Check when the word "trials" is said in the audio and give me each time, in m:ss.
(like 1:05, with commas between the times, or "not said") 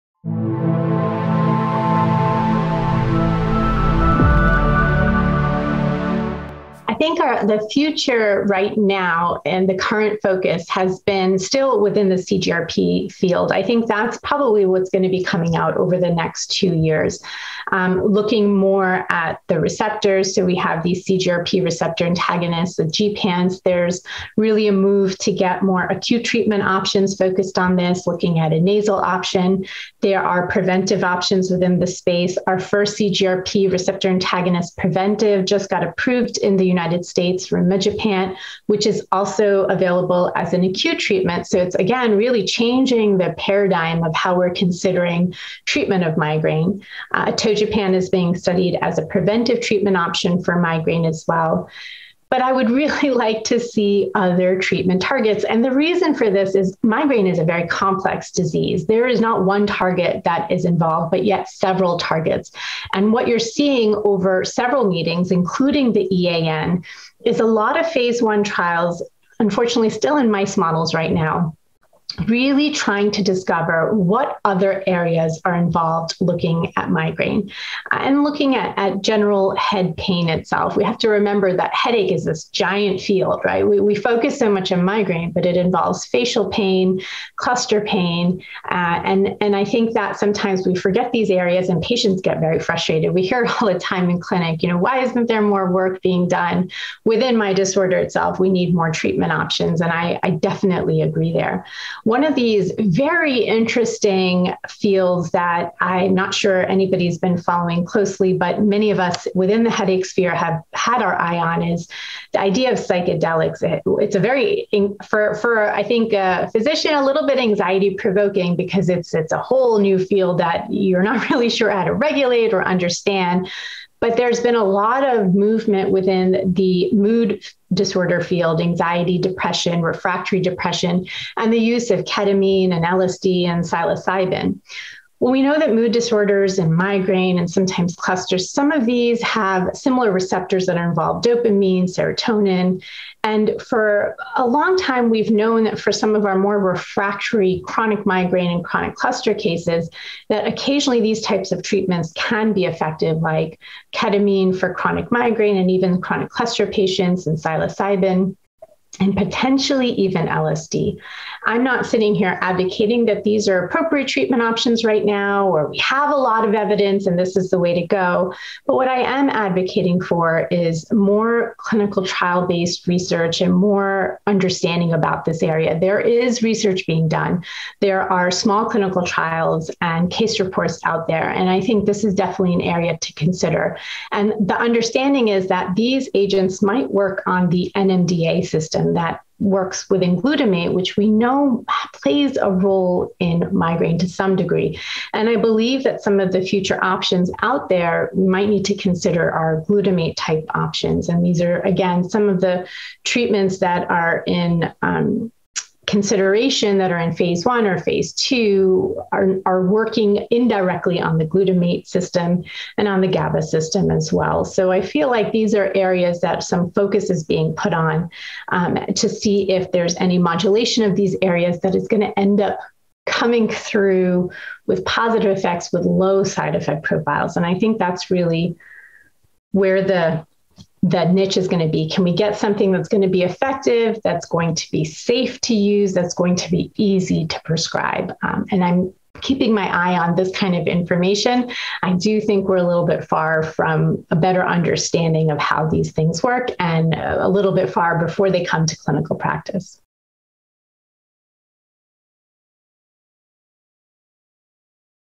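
1:08, 2:52, 2:59.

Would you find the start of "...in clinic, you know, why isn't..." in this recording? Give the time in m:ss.
1:34.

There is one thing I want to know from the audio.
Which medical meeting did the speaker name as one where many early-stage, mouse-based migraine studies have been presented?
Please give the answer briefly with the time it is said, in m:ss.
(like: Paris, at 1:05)
EAN, at 1:06.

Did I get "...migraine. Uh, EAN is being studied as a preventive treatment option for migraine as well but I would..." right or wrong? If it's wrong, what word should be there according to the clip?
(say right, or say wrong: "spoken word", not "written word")
wrong: "Togepan", not "EAN".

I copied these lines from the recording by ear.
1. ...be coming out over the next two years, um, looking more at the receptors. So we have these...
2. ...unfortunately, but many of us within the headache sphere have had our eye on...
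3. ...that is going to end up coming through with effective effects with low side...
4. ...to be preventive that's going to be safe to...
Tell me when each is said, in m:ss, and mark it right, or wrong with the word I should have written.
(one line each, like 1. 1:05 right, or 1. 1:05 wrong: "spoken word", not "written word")
1. 0:15 right
2. 1:47 wrong: "closely", not "unfortunately"
3. 3:41 wrong: "positive", not "effective"
4. 3:53 wrong: "effective", not "preventive".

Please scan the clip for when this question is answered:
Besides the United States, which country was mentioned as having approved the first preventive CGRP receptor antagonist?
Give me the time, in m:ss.
0:37.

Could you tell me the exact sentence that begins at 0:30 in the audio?
There are preventive options within the space.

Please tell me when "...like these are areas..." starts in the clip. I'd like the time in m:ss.
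3:35.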